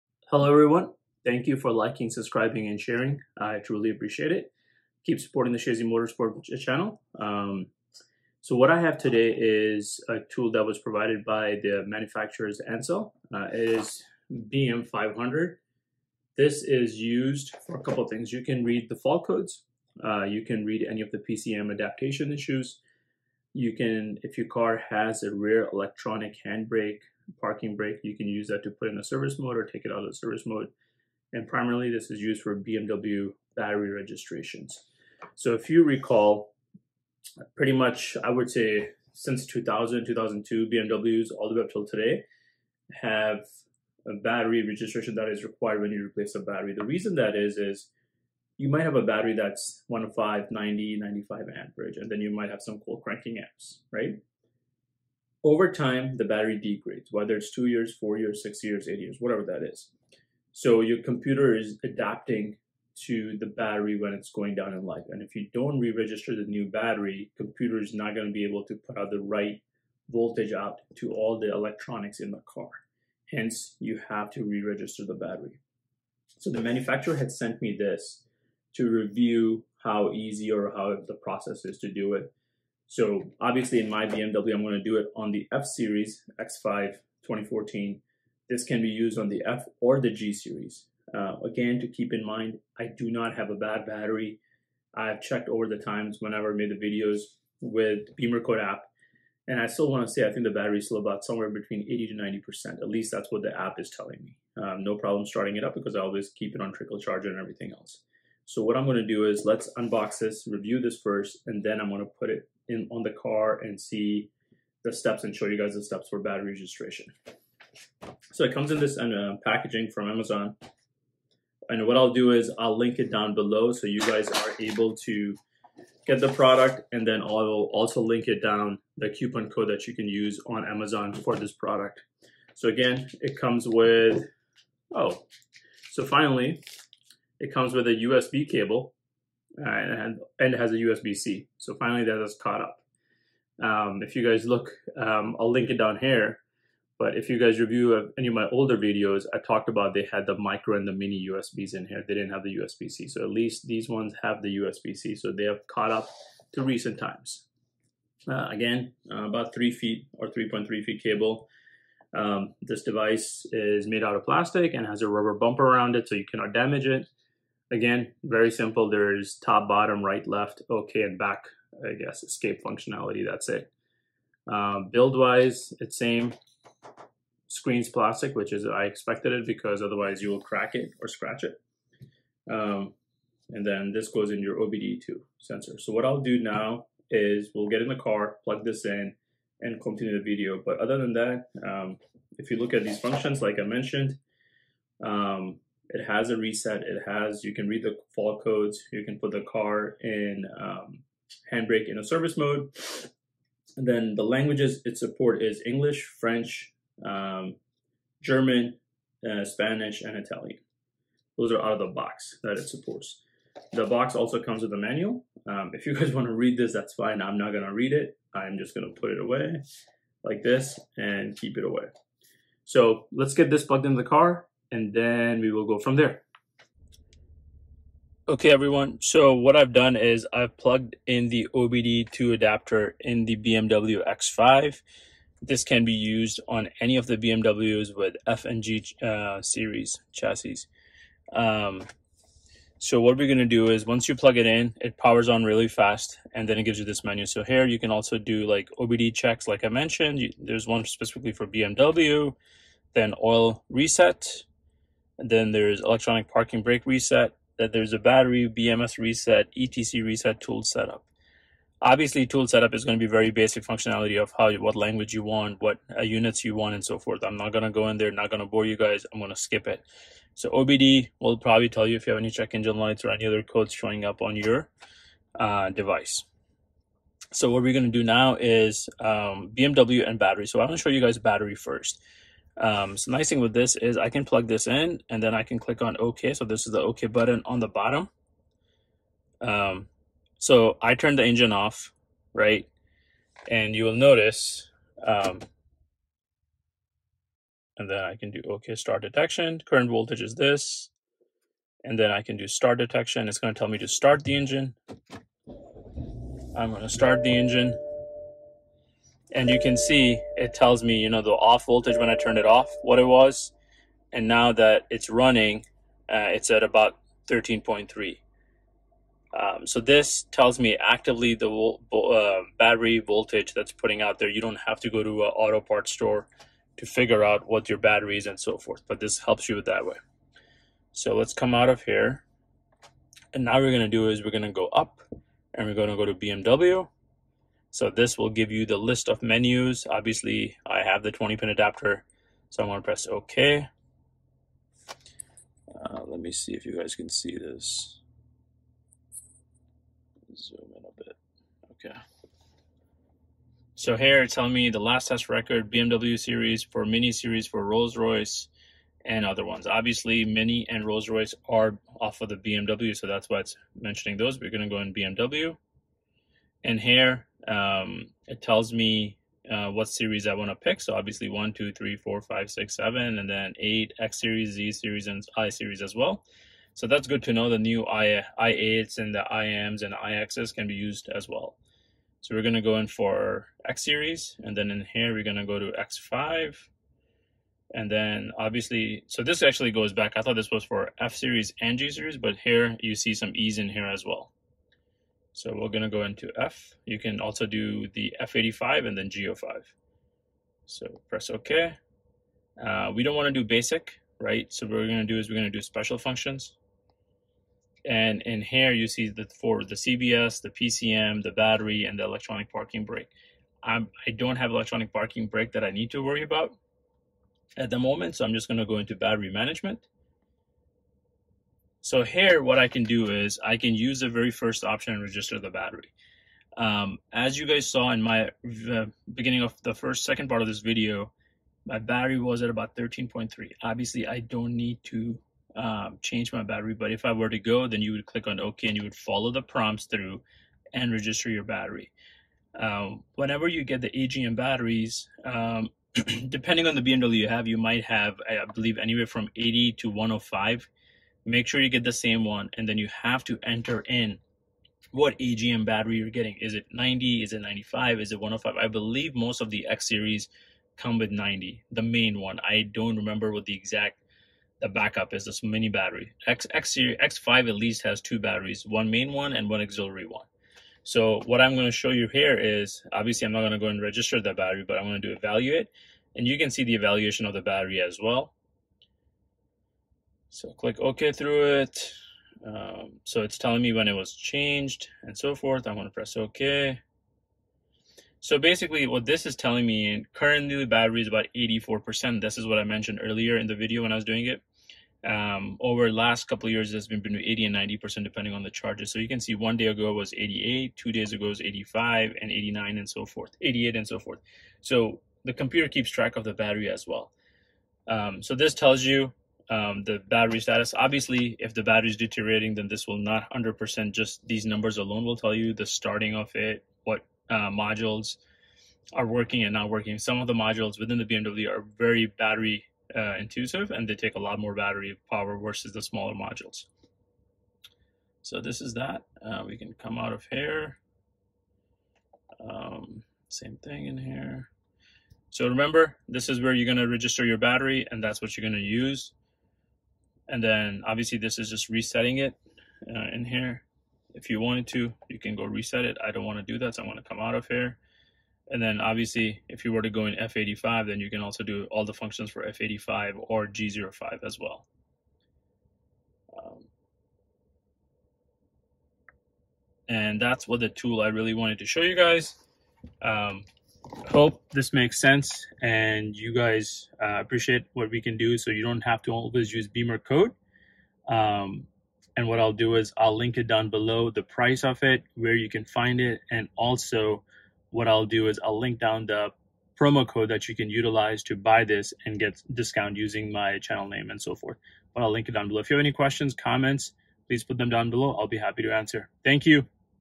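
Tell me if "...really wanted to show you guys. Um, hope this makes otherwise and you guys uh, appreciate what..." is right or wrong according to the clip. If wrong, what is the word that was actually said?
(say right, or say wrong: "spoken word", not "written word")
wrong: "sense", not "otherwise".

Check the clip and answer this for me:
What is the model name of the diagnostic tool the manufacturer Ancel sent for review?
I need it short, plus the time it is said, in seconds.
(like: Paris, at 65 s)
BM500, at 14 s.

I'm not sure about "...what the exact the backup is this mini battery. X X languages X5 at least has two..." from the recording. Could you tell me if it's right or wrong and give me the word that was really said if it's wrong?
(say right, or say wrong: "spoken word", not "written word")
wrong: "series", not "languages".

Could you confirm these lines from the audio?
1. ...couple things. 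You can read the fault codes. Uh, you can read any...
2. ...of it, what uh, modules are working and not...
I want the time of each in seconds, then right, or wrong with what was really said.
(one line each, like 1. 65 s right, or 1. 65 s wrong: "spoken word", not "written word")
1. 17 s right
2. 516 s right.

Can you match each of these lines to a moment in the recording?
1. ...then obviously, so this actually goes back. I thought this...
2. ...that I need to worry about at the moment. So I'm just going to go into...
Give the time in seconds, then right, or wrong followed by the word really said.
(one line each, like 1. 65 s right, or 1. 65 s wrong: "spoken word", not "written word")
1. 387 s right
2. 415 s right.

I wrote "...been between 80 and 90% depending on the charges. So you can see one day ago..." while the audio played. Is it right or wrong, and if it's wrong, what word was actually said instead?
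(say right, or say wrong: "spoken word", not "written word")
right.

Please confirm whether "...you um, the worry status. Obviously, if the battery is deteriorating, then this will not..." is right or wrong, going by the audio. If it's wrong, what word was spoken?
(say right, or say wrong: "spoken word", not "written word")
wrong: "battery", not "worry".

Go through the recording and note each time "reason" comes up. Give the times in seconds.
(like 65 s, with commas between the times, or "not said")
46 s.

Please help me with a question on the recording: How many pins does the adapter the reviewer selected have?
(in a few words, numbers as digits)
20.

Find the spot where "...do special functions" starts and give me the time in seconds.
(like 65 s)
405 s.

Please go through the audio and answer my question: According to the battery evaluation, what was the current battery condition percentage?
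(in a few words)
84%.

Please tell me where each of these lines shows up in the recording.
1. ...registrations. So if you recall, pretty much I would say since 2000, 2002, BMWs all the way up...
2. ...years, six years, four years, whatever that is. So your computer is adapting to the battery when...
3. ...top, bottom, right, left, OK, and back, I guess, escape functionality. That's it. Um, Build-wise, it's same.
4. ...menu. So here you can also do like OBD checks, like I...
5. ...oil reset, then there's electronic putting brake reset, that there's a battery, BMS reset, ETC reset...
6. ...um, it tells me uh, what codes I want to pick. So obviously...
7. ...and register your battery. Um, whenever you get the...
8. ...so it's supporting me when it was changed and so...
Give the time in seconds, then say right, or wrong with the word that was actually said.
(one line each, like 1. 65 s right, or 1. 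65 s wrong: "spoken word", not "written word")
1. 33 s right
2. 58 s wrong: "eight", not "four"
3. 169 s right
4. 247 s right
5. 253 s wrong: "parking", not "putting"
6. 367 s wrong: "series", not "codes"
7. 440 s right
8. 483 s wrong: "telling", not "supporting".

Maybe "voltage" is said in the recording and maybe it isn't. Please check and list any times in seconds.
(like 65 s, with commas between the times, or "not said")
70 s, 299 s, 311 s, 322 s.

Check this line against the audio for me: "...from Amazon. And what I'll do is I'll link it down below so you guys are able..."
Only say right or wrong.
right.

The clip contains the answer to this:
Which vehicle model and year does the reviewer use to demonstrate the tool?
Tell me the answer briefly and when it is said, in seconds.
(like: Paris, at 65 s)
X5 2014, at 86 s.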